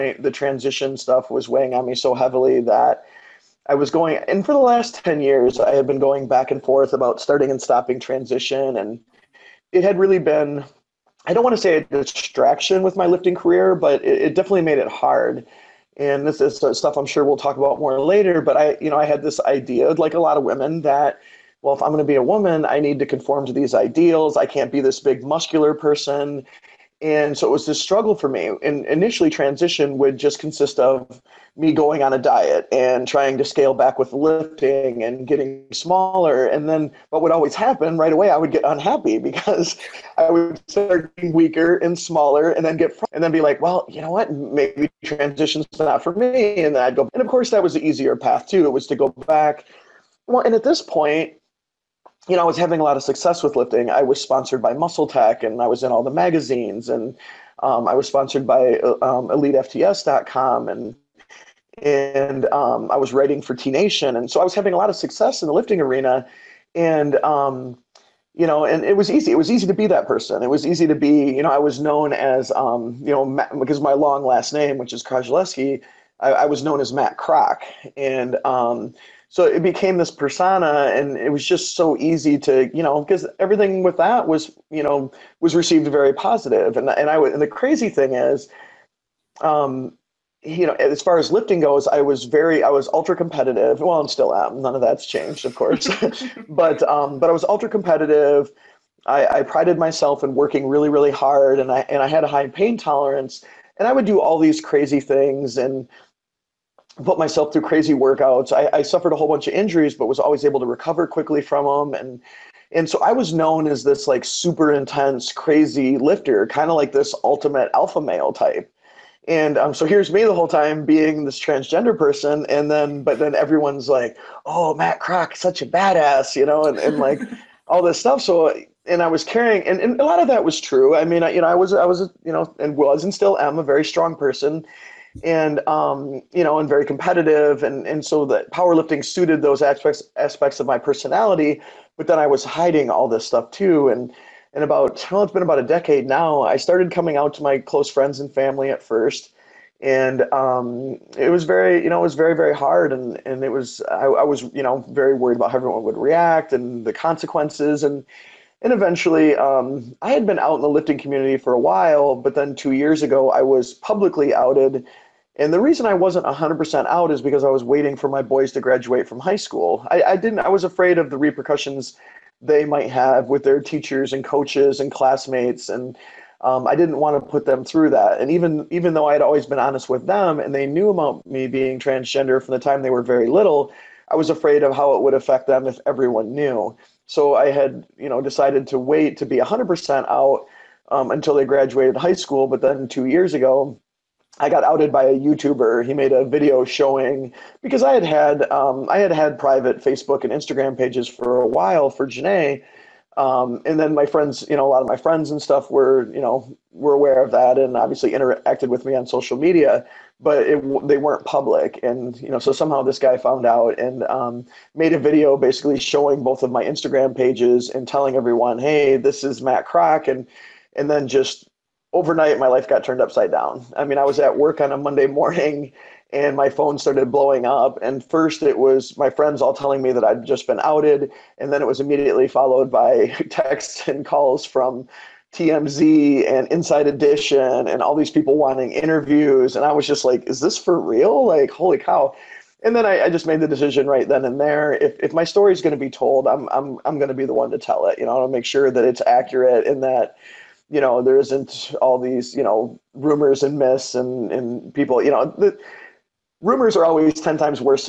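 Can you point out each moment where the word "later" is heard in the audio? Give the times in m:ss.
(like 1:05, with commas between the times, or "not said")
0:17.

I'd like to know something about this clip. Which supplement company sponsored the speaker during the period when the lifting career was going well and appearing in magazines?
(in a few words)
MuscleTech.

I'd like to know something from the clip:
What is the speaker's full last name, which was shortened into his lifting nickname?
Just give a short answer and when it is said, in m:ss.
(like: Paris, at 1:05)
Krajleski, at 1:15.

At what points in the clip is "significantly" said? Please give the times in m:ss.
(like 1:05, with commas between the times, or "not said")
not said.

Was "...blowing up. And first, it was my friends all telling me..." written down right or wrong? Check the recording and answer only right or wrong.
right.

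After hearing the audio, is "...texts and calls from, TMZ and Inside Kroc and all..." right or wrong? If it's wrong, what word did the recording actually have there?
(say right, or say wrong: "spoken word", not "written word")
wrong: "Edition", not "Kroc".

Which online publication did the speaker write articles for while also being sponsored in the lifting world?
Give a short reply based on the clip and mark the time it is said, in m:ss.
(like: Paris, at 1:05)
T Nation, at 1:03.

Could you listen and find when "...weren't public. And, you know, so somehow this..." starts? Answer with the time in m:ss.
3:30.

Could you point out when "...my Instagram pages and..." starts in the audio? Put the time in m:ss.
3:36.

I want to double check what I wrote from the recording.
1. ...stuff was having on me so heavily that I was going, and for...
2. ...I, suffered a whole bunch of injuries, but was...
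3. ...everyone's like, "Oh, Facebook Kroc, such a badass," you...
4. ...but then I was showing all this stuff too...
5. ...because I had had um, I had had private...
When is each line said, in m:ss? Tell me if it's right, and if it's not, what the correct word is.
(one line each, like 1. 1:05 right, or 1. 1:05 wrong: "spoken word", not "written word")
1. 0:00 wrong: "weighing", not "having"
2. 1:48 right
3. 2:03 wrong: "Matt", not "Facebook"
4. 2:21 wrong: "hiding", not "showing"
5. 3:17 right.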